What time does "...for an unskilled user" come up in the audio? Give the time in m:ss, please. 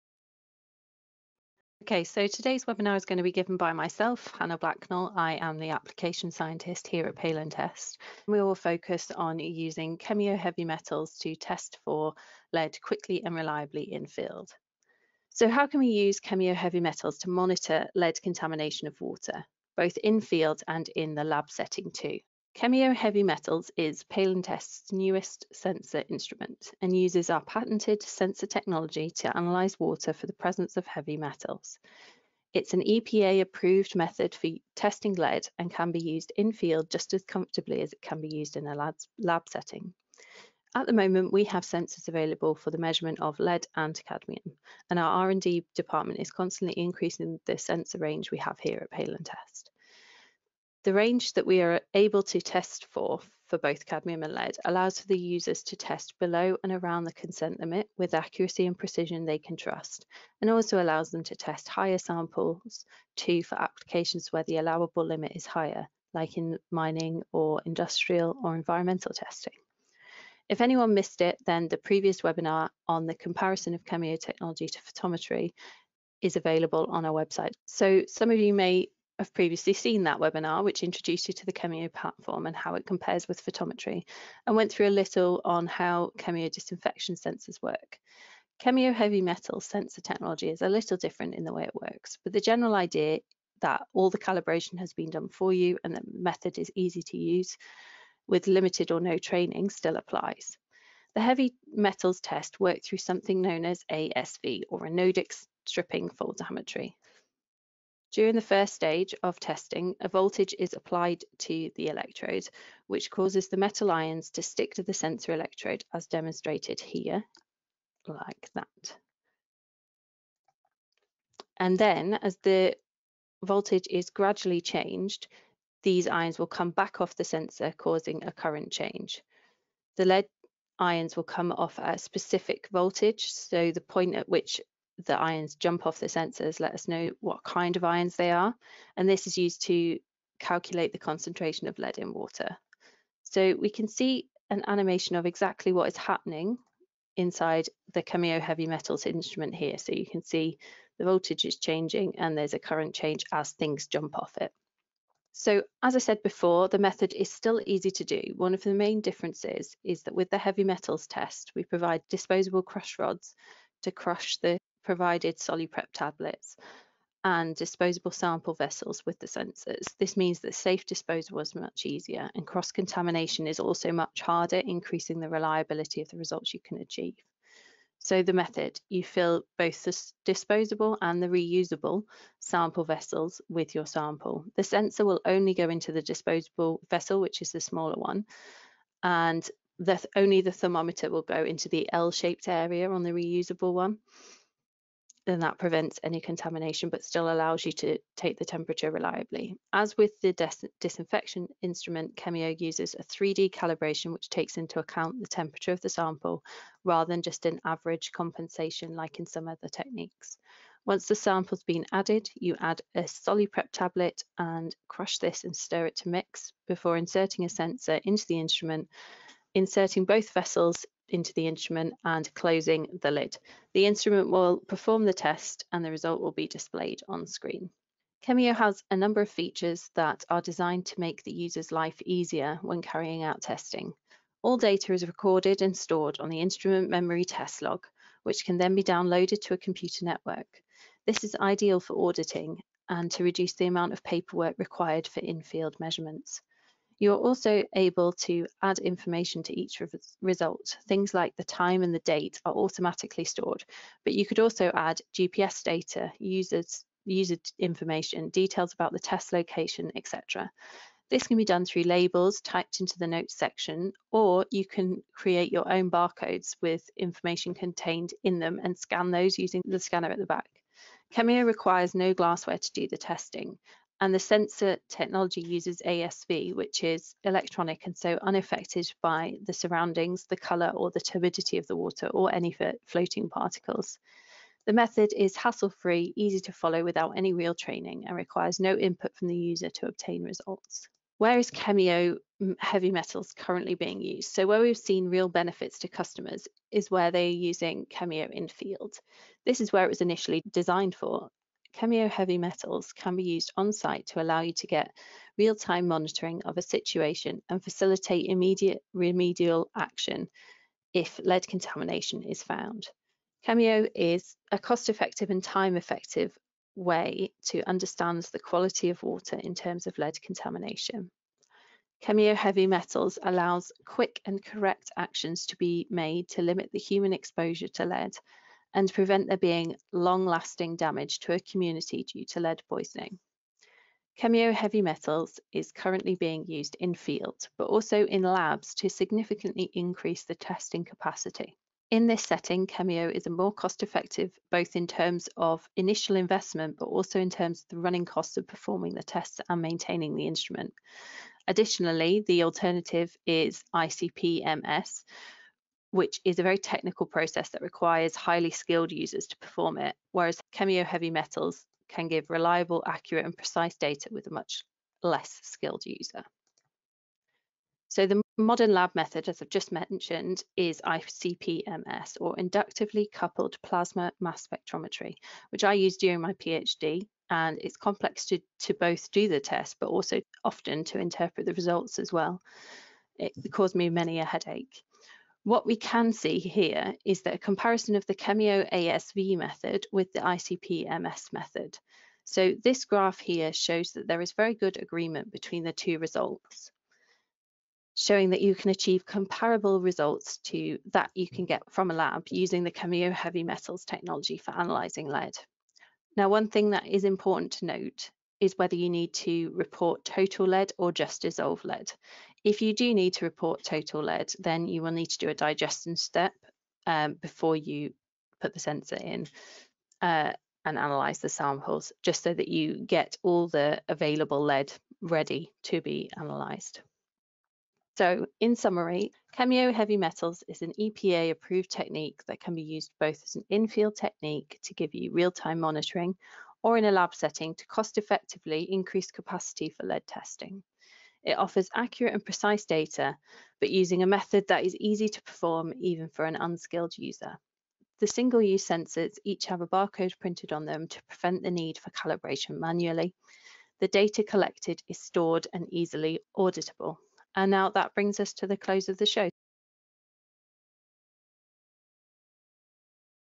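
7:26.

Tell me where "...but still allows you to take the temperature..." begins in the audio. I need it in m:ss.
3:16.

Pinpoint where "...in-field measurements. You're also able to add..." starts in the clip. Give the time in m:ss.
4:05.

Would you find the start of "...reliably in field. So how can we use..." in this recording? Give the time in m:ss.
0:13.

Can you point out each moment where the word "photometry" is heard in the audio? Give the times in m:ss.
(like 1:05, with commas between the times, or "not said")
1:14, 1:23.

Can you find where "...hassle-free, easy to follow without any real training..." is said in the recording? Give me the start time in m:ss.
4:45.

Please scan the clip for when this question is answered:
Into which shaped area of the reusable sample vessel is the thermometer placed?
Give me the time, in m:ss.
3:11.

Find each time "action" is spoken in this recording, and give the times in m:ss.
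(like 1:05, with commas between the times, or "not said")
5:09, 5:24.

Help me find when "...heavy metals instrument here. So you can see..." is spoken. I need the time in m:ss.
2:28.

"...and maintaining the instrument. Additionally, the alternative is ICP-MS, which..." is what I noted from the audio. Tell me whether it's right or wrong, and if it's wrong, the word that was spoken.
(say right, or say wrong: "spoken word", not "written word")
right.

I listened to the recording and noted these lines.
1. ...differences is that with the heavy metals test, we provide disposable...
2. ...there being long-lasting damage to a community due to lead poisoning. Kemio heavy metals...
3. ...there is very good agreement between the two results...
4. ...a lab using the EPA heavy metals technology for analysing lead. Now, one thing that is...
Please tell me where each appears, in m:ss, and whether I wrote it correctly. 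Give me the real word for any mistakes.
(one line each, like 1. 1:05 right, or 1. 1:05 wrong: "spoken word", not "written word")
1. 2:38 right
2. 5:29 right
3. 6:34 right
4. 6:41 wrong: "Kemio", not "EPA".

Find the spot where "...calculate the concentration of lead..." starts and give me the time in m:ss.
2:20.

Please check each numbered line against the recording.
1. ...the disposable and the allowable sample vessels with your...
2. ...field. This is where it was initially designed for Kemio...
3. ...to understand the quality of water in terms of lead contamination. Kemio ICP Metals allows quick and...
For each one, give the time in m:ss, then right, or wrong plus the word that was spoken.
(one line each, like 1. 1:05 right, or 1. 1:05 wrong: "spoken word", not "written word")
1. 2:59 wrong: "reusable", not "allowable"
2. 4:58 right
3. 5:17 wrong: "Heavy", not "ICP".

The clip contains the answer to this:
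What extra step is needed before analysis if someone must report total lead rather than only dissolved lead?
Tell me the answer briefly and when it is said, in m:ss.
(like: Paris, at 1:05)
Digestion step, at 6:55.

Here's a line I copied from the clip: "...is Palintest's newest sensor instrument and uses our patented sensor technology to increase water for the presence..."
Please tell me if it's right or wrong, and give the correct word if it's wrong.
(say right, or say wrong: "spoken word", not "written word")
wrong: "analyse", not "increase".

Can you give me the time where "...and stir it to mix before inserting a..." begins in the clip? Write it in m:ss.
3:35.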